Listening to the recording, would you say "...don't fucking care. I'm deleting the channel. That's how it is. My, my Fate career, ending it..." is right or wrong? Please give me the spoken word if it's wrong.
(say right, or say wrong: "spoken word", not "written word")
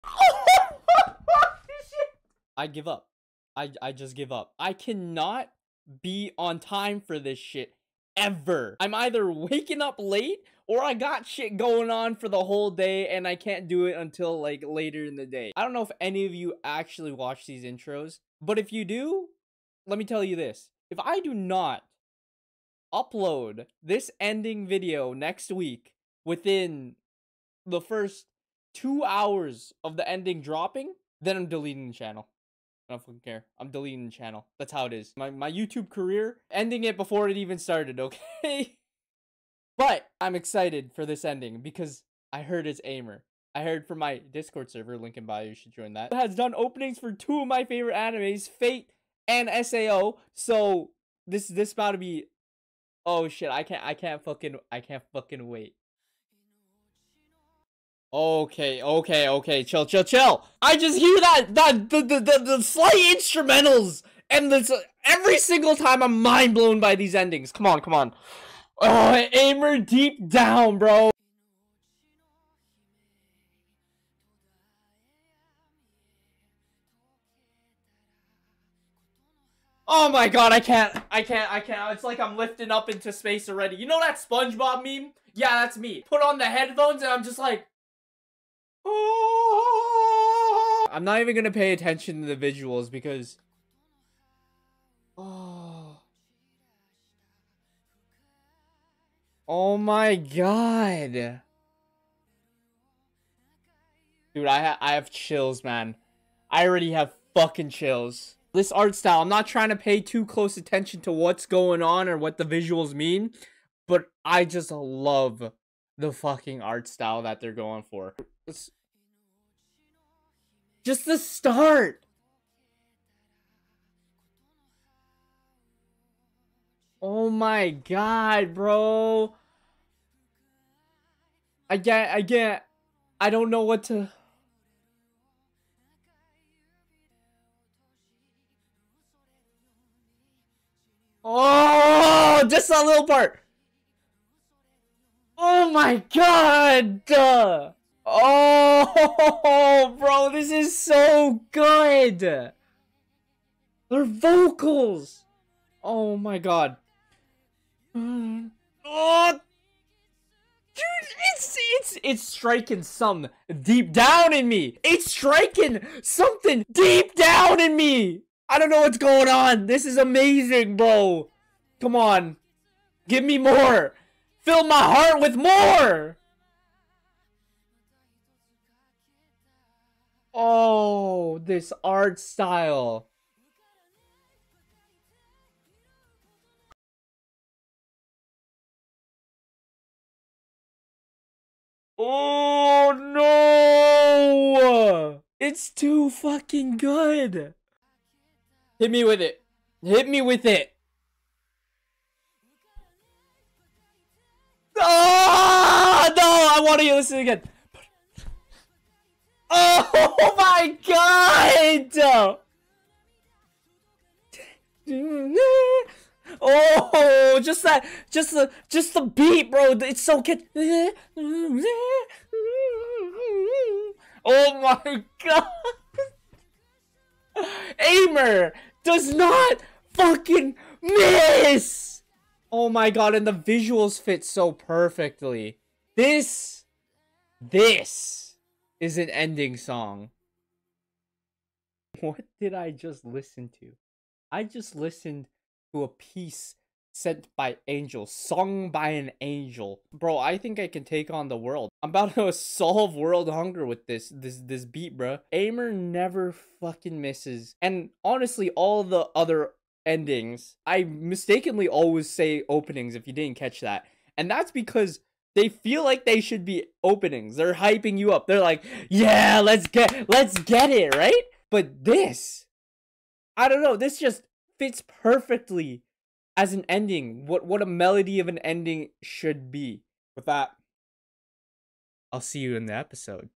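wrong: "YouTube", not "Fate".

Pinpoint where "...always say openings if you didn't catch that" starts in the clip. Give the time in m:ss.
4:21.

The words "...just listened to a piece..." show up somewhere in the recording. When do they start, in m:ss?
4:04.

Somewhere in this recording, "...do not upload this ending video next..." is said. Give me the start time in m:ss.
0:21.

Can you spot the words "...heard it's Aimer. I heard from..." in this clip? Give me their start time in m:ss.
0:42.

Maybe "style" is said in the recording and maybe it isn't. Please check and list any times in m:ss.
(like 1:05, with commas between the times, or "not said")
1:48, 1:56, 3:02.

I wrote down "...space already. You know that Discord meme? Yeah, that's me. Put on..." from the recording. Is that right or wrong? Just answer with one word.
wrong.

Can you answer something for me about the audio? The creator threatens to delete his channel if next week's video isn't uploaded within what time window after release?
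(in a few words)
2 hours.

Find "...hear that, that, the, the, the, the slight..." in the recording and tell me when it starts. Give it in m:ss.
1:00.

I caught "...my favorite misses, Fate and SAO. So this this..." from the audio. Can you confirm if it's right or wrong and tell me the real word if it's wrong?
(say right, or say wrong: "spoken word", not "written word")
wrong: "animes", not "misses".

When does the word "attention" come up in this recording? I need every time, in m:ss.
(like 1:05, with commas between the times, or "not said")
1:31, 1:50.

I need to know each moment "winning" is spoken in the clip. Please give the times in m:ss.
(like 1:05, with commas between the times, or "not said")
not said.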